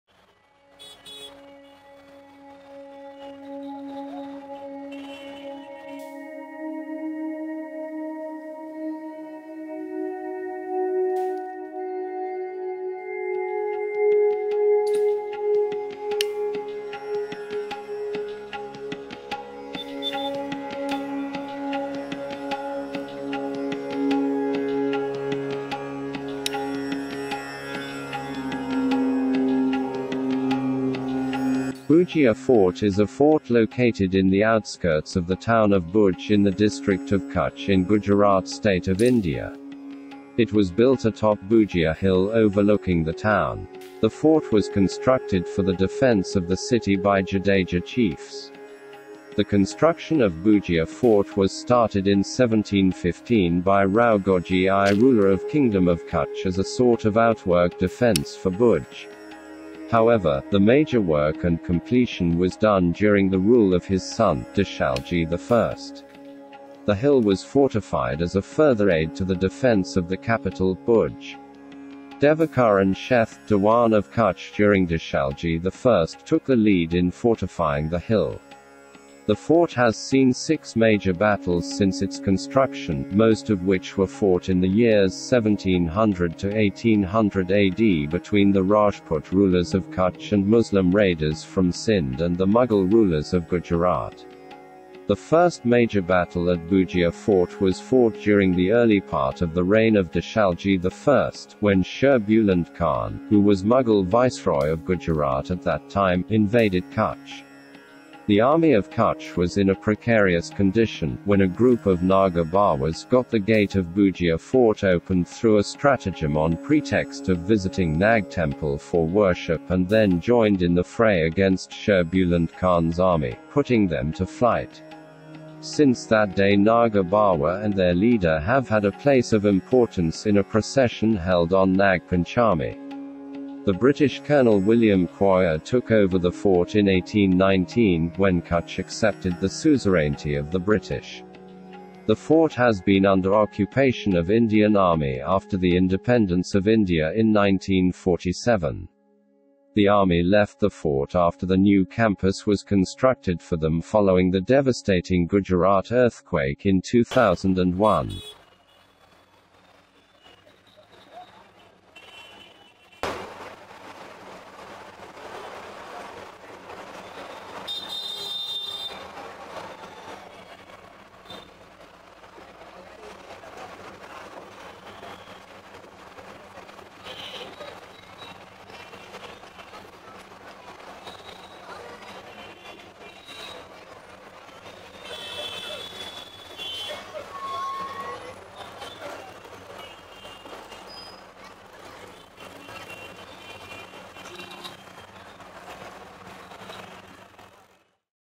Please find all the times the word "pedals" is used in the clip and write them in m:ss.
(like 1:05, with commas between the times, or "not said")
not said.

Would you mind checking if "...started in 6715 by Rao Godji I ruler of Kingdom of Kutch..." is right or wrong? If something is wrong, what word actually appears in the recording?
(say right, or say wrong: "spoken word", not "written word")
wrong: "1715", not "6715".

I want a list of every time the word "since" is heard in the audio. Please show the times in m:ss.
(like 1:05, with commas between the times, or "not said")
1:21, 2:05.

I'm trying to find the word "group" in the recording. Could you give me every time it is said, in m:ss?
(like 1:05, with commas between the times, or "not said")
1:51.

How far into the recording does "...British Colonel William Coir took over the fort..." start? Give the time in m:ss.
2:13.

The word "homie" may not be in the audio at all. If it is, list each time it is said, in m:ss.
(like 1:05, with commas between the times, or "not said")
not said.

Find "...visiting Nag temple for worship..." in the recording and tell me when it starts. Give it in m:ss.
1:57.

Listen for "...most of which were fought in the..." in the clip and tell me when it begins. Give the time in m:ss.
1:23.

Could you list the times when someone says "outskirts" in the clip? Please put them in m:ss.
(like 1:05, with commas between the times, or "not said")
0:34.